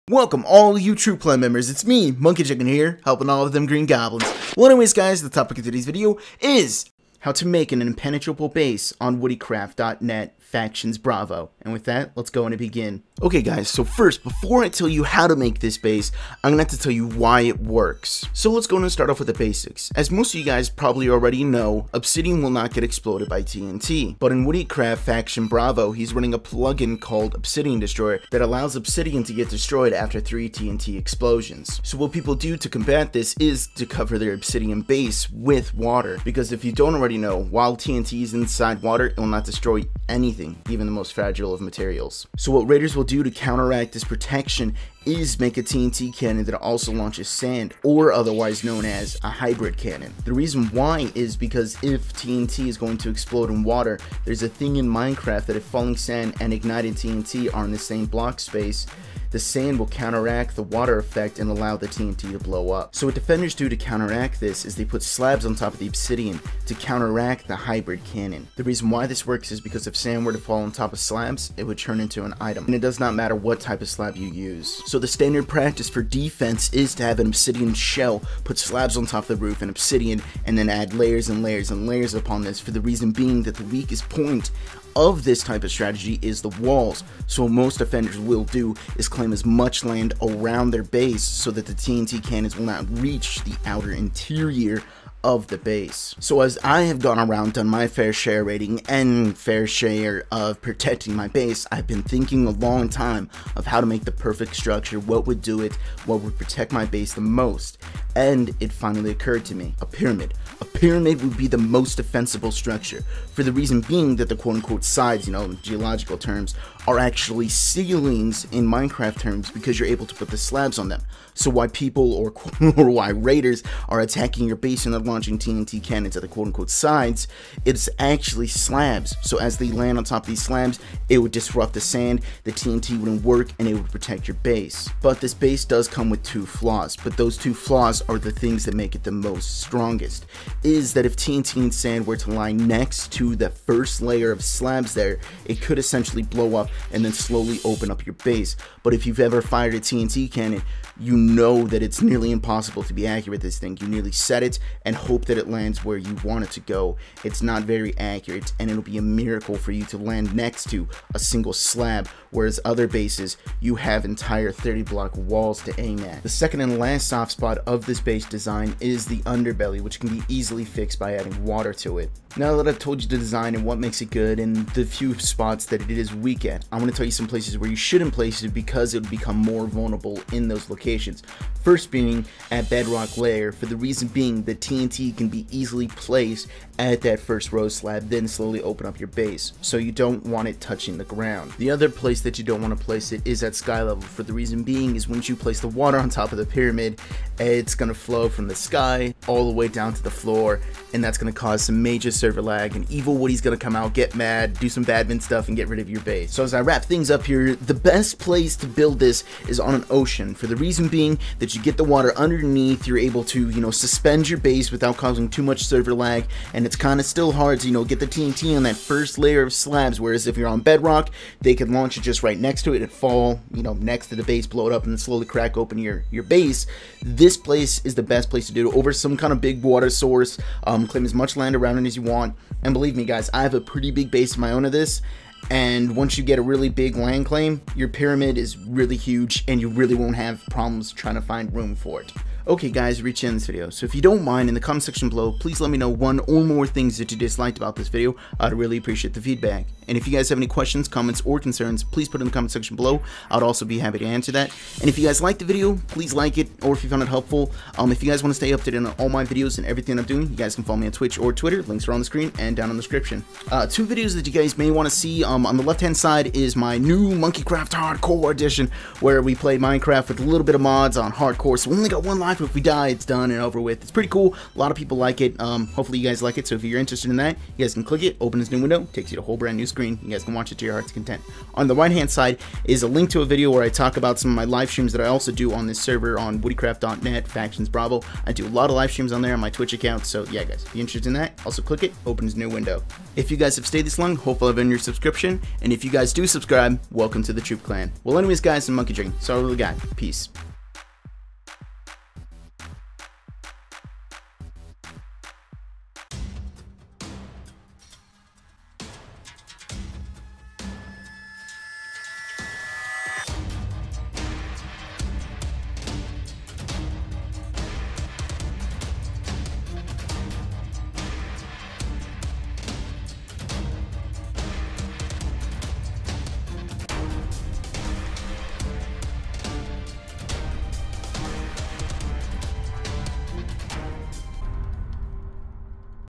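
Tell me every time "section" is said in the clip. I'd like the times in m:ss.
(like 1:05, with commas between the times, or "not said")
4:04, 4:12.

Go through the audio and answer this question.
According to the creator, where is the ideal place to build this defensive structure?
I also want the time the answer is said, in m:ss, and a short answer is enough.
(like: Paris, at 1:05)
an ocean, at 3:29.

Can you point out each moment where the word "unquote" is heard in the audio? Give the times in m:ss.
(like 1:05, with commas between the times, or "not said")
1:54, 2:06.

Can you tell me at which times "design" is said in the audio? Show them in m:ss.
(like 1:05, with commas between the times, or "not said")
2:48, 2:53.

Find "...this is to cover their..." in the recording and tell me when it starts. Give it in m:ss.
0:33.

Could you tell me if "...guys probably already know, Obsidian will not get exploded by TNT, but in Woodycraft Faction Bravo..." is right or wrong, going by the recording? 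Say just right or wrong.
right.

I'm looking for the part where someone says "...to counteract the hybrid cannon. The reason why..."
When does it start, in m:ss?
1:06.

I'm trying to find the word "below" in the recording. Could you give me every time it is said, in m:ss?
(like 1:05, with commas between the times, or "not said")
4:05, 4:12.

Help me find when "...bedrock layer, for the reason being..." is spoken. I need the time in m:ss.
3:02.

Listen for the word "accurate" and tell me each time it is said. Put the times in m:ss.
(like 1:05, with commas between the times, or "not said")
2:33, 2:37.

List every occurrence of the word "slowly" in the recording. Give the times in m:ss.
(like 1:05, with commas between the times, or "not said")
2:27, 3:08, 3:44.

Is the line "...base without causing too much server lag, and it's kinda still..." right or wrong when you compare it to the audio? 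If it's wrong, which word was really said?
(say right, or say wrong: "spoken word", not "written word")
right.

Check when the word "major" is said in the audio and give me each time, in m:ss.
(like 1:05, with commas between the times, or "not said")
3:21.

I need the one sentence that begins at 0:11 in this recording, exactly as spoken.
And with that, let's go and begin.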